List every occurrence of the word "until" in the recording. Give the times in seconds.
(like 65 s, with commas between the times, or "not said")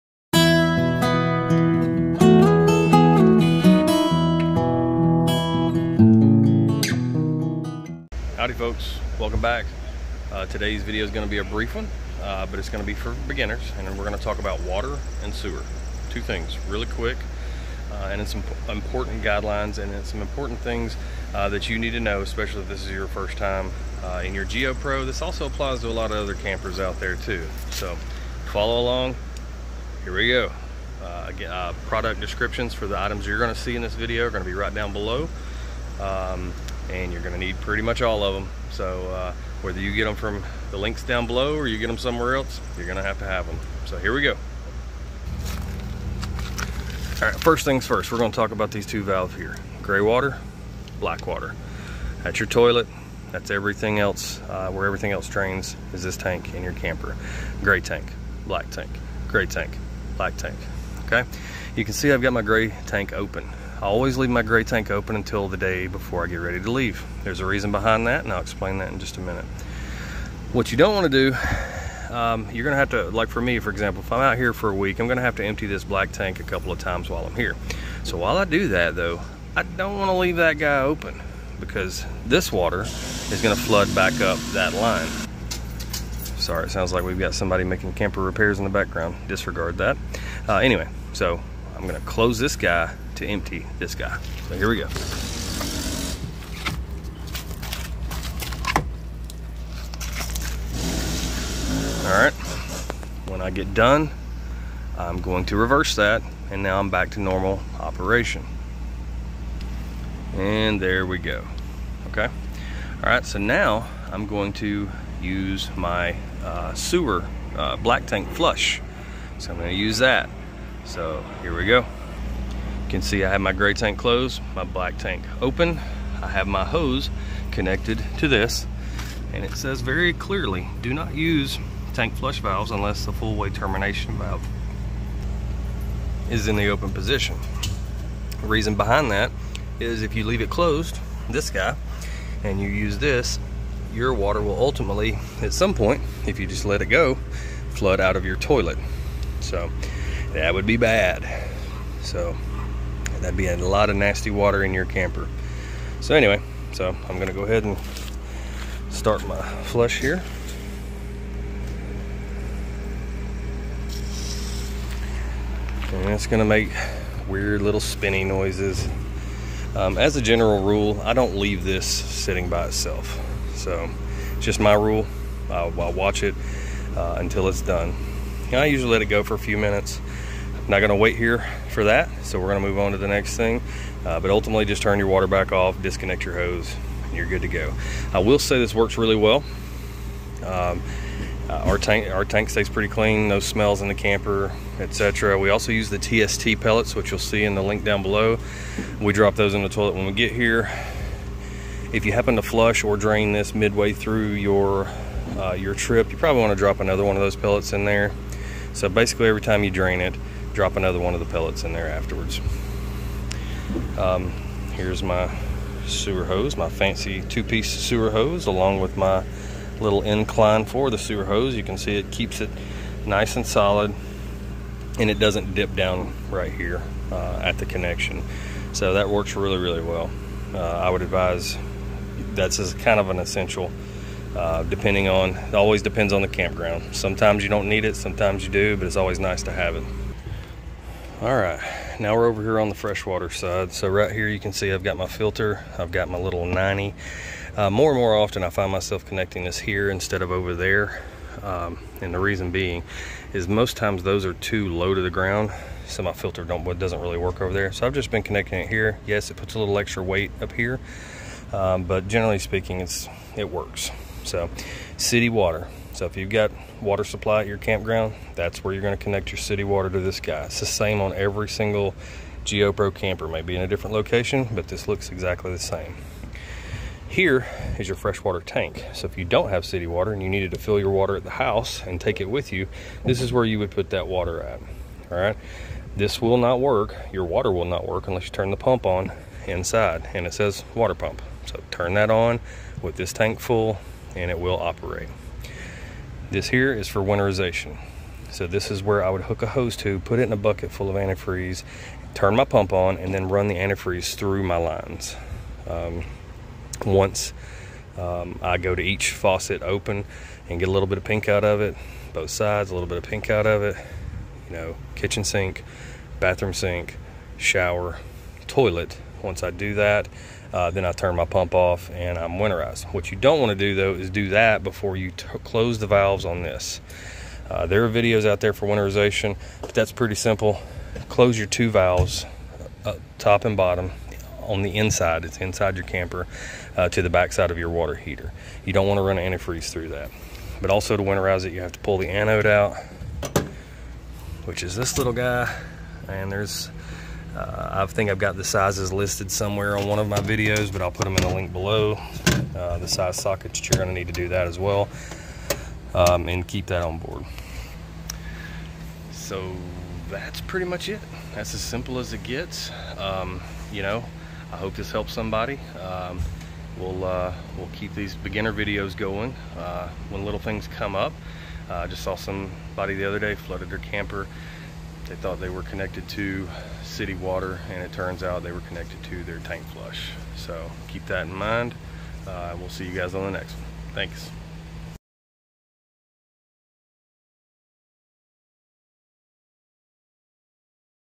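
65 s, 177 s.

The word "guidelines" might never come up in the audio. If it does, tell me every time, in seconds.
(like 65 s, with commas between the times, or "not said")
19 s.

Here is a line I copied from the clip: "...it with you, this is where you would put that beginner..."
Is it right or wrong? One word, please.
wrong.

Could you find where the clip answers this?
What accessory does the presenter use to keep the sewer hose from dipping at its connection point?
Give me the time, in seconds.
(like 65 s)
219 s.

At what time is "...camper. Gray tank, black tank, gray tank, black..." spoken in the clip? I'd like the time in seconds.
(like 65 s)
56 s.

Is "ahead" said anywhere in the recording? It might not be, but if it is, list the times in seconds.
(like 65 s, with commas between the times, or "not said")
157 s.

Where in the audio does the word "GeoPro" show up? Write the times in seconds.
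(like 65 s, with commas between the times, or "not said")
24 s, 272 s.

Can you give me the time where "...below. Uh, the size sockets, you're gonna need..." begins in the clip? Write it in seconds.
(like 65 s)
351 s.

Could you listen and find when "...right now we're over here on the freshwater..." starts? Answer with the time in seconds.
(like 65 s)
241 s.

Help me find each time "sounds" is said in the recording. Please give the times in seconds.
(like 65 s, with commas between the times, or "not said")
86 s.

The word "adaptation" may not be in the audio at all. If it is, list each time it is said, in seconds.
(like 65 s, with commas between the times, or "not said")
not said.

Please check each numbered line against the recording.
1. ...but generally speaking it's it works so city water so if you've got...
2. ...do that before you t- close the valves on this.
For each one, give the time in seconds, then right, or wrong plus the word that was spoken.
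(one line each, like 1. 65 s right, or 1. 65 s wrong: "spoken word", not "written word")
1. 261 s right
2. 324 s right.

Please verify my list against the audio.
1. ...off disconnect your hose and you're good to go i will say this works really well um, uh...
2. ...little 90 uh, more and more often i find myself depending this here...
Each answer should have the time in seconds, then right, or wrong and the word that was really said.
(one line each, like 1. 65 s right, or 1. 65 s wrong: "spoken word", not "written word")
1. 185 s right
2. 246 s wrong: "connecting", not "depending".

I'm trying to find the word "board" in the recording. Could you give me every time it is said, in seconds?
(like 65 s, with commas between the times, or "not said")
356 s.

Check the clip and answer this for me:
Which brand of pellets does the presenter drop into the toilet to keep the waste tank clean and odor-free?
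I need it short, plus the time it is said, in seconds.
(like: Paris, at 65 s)
TST, at 195 s.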